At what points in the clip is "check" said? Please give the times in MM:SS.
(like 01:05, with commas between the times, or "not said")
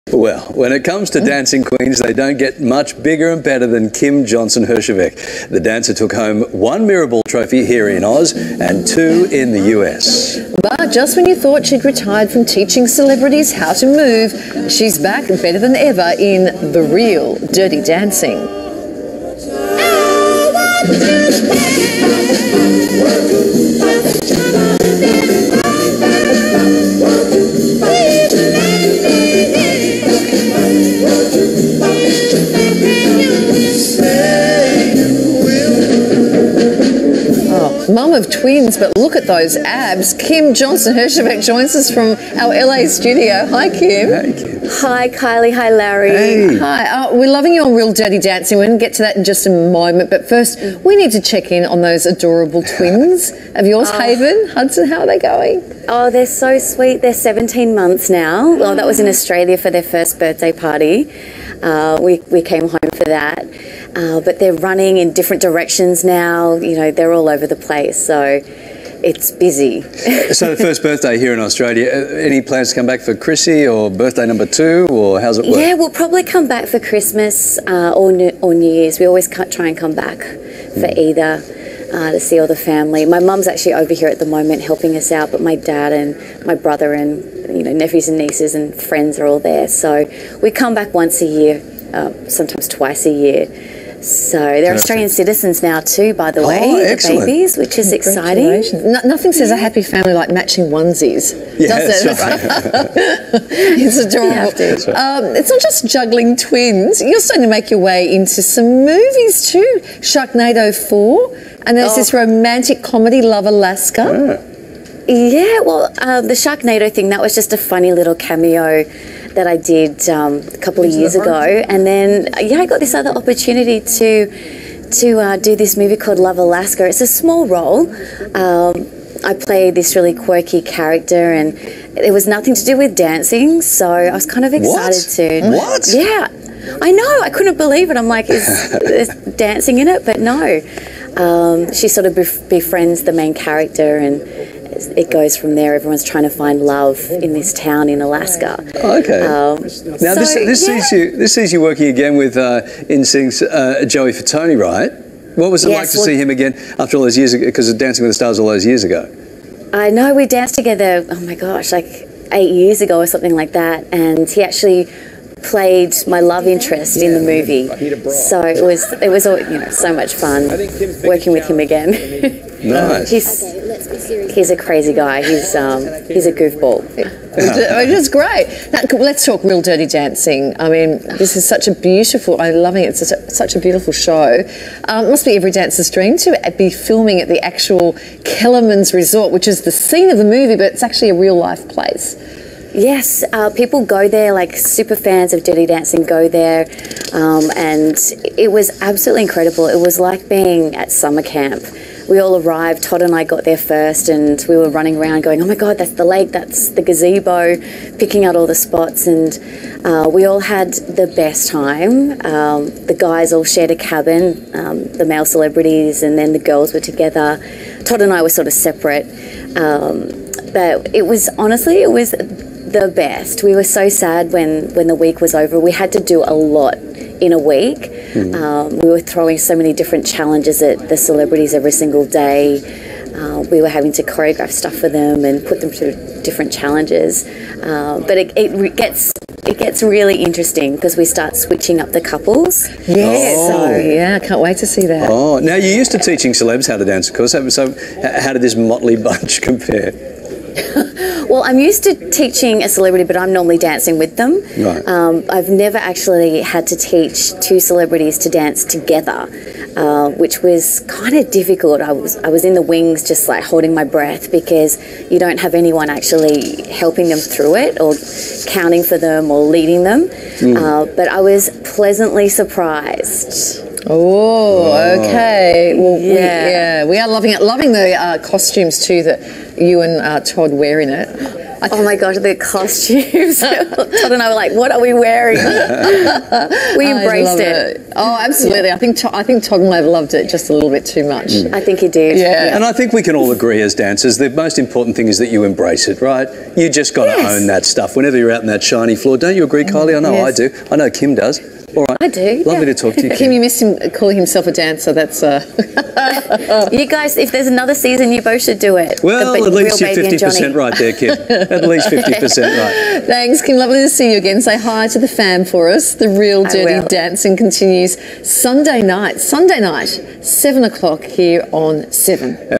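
00:51.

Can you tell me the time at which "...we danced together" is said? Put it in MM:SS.
02:40.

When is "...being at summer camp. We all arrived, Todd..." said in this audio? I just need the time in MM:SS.
03:20.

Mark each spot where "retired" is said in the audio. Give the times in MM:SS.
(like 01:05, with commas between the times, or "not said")
00:11.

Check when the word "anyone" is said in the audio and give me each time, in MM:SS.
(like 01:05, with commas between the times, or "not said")
04:25.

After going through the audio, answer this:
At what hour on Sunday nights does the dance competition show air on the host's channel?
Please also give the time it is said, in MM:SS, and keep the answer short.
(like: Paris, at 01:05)
7 o'clock, at 05:20.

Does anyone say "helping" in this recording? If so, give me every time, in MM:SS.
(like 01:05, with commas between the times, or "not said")
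01:24, 04:26.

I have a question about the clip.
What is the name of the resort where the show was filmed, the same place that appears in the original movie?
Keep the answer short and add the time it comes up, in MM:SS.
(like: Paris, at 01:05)
Kellerman's Resort, at 03:08.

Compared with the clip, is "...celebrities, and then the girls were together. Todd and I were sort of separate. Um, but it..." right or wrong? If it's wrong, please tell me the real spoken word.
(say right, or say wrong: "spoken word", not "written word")
right.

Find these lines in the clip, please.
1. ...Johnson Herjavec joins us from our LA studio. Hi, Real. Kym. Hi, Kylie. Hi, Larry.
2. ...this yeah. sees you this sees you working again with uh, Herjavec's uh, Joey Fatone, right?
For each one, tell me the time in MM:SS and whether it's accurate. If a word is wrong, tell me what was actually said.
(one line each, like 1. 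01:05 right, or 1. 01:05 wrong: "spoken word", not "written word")
1. 00:40 wrong: "Kym", not "Real"
2. 02:30 wrong: "NSYNC", not "Herjavec".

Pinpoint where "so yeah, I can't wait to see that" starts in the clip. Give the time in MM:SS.
04:03.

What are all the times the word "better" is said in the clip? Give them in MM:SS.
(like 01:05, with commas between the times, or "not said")
00:03, 00:15.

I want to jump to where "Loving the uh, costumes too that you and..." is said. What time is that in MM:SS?
04:37.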